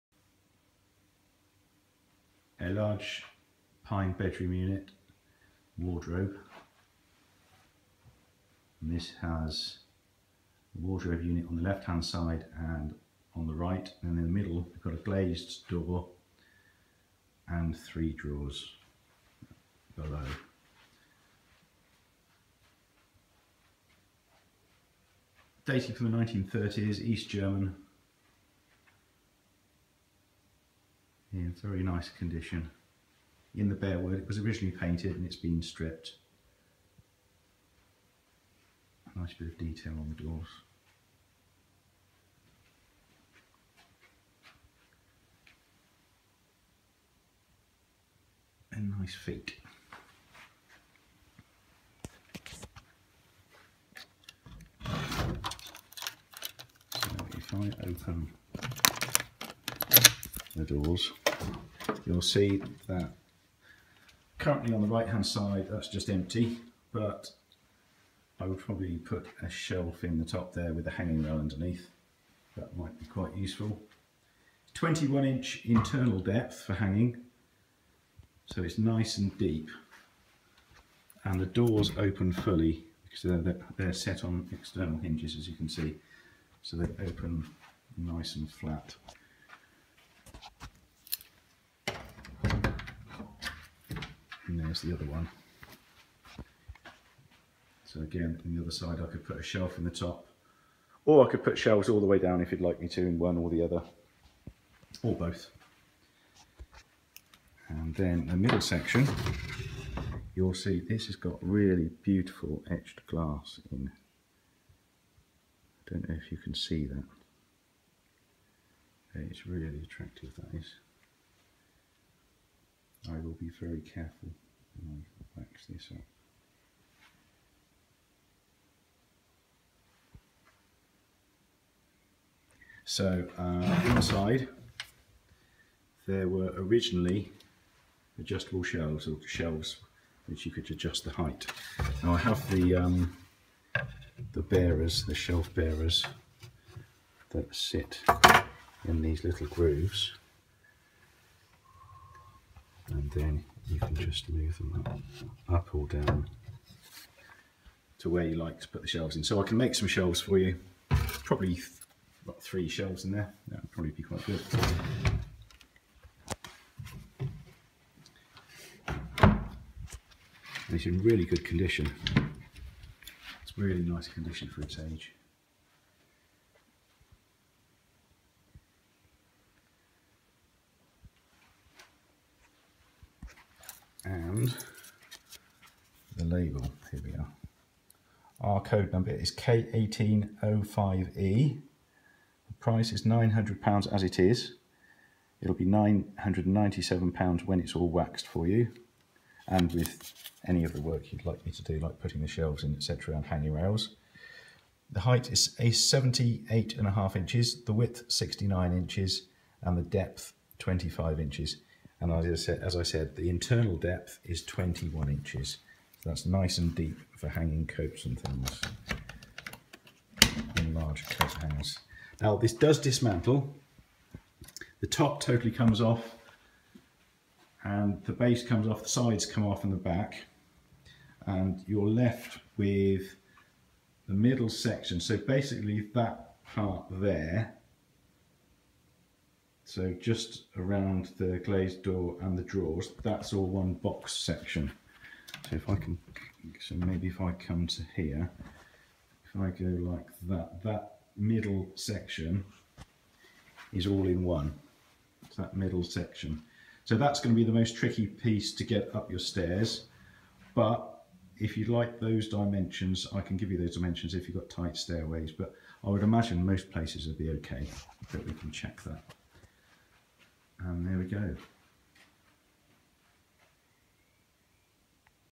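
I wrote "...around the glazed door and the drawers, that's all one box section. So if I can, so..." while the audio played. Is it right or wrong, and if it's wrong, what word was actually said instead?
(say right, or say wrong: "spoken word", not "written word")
right.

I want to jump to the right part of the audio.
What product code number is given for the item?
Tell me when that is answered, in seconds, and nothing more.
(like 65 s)
189 s.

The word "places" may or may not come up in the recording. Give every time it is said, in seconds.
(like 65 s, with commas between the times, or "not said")
266 s.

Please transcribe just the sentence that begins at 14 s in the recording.
And in the middle, we've got a glazed door and three drawers below.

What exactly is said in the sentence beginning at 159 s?
So I can make some shelves for you, probably about three shelves in there, that would probably be quite good.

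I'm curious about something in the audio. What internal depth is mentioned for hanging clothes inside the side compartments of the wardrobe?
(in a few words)
21 inches.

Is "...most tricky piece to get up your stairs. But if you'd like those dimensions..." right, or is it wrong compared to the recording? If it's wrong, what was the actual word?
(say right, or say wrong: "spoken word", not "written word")
right.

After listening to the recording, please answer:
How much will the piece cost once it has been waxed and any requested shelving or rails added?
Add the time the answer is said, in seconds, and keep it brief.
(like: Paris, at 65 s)
£997, at 195 s.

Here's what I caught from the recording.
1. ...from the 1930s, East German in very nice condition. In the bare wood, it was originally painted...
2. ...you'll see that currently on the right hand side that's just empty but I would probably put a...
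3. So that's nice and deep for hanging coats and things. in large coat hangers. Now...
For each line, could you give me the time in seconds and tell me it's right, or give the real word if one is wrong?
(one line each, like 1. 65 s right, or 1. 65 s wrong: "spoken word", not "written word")
1. 25 s right
2. 62 s right
3. 216 s right.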